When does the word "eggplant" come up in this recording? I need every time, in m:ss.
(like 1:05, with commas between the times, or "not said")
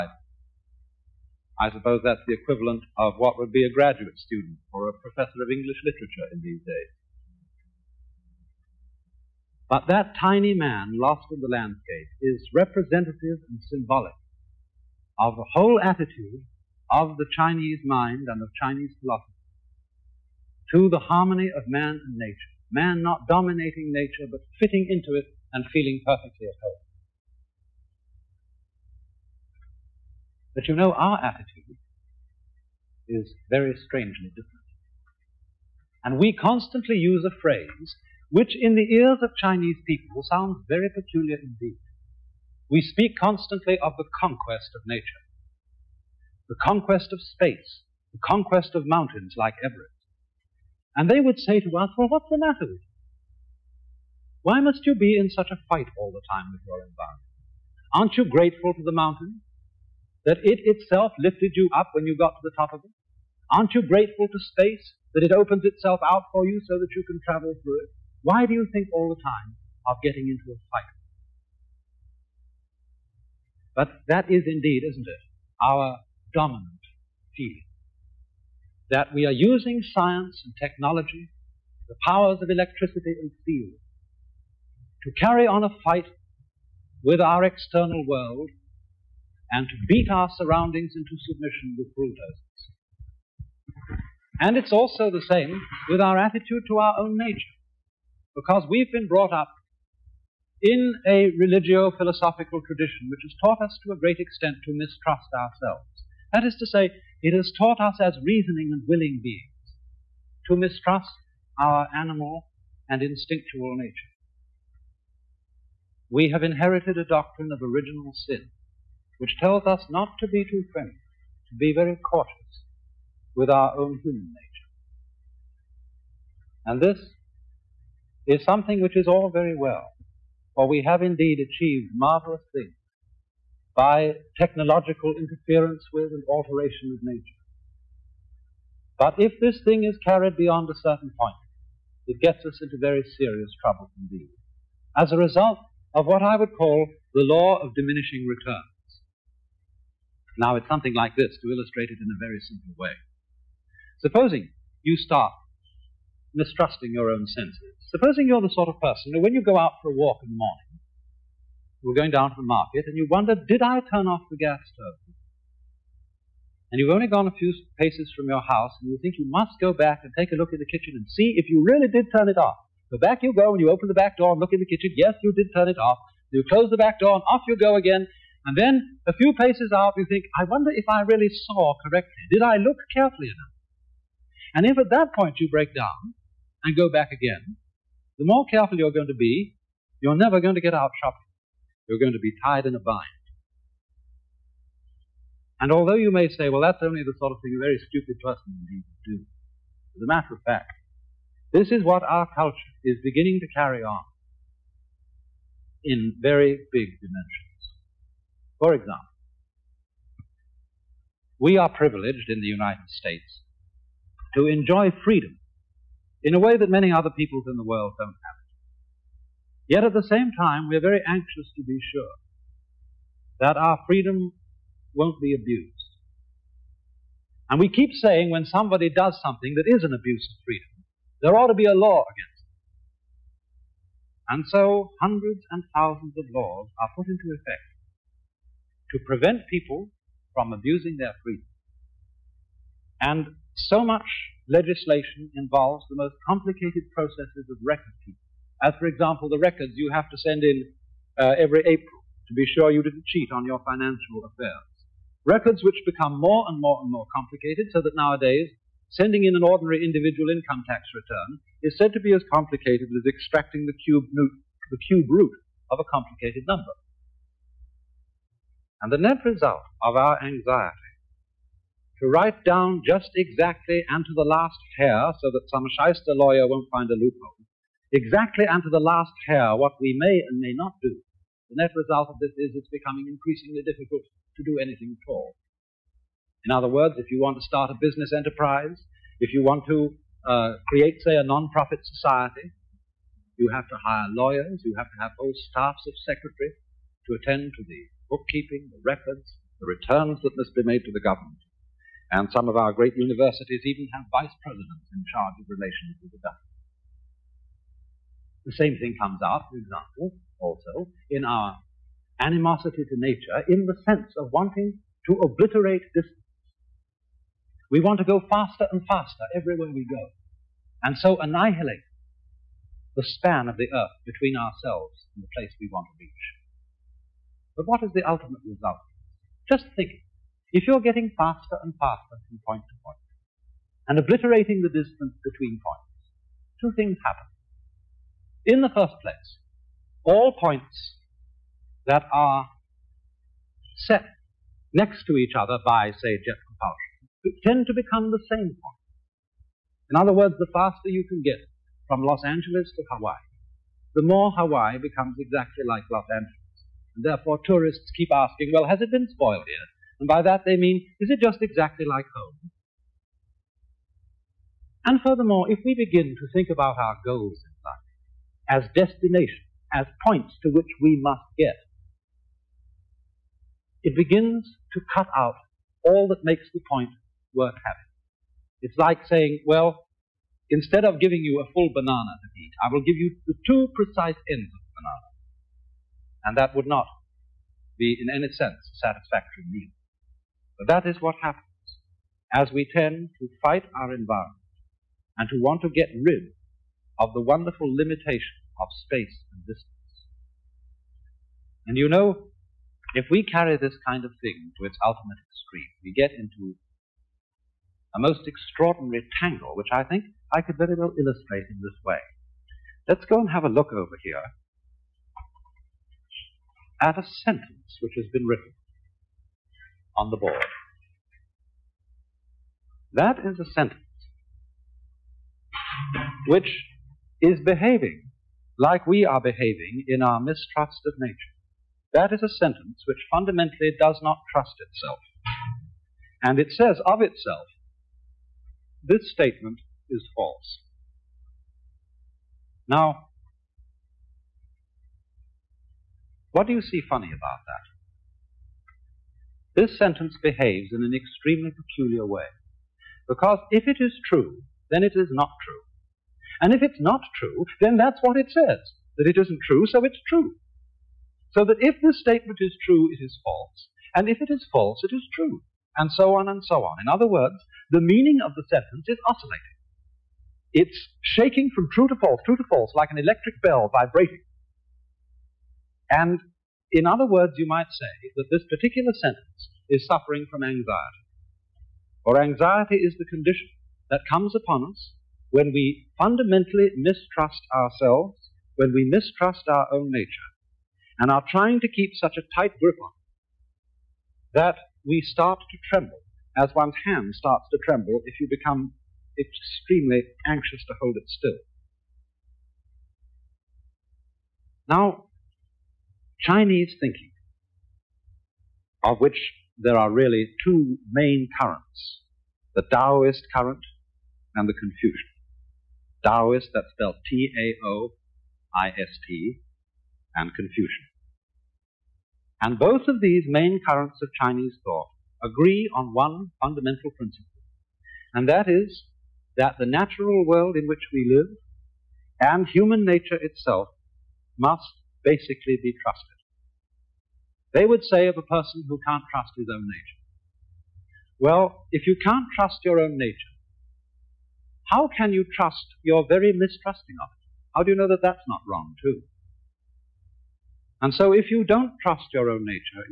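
not said.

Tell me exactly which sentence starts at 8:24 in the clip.
Now, Chinese thinking, of which there are really two main currents the Taoist current and the Confucian.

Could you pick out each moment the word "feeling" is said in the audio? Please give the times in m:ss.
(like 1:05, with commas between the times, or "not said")
0:25, 1:17.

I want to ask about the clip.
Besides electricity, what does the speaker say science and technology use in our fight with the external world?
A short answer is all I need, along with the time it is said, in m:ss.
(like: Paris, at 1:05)
steel, at 1:23.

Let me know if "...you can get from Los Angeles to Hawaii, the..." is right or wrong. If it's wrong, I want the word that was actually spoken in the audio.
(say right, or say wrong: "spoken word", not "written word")
right.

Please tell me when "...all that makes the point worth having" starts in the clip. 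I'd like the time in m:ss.
6:15.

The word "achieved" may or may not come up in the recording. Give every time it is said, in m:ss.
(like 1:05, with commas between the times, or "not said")
2:11.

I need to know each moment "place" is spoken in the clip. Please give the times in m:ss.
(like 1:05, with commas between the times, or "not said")
5:25, 5:39.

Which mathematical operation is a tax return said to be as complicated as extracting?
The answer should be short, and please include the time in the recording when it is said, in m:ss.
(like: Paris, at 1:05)
cube root, at 4:24.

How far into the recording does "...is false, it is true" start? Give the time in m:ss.
7:44.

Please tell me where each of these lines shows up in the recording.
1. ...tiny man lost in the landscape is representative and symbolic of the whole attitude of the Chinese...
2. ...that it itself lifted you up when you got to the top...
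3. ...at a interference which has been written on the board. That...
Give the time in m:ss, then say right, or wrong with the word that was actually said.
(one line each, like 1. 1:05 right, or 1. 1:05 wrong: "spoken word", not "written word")
1. 0:10 right
2. 1:00 right
3. 6:56 wrong: "sentence", not "interference".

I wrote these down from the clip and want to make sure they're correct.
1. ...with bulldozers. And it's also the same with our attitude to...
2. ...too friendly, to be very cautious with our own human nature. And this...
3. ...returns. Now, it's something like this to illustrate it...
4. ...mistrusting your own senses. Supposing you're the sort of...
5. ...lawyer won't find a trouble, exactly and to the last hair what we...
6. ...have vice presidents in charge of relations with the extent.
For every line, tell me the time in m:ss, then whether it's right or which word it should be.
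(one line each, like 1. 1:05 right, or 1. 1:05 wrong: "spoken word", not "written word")
1. 1:31 right
2. 2:00 right
3. 2:28 right
4. 2:36 right
5. 4:36 wrong: "loophole", not "trouble"
6. 5:03 wrong: "government", not "extent".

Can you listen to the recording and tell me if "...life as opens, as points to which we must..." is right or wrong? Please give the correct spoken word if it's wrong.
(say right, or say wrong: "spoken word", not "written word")
wrong: "destinations", not "opens".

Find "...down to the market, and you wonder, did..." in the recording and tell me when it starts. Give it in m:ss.
2:42.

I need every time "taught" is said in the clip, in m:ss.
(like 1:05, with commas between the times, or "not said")
1:43, 1:47.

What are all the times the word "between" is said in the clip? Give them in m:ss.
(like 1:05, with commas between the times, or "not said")
5:24, 5:35.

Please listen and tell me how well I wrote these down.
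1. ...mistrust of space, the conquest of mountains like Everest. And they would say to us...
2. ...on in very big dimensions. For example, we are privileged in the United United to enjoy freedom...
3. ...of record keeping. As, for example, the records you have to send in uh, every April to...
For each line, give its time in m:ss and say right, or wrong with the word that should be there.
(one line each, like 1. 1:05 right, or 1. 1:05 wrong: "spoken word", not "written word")
1. 0:46 wrong: "conquest", not "mistrust"
2. 3:23 wrong: "States", not "United"
3. 4:07 right.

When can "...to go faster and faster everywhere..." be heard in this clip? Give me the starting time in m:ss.
5:17.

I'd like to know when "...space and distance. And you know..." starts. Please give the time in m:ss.
6:38.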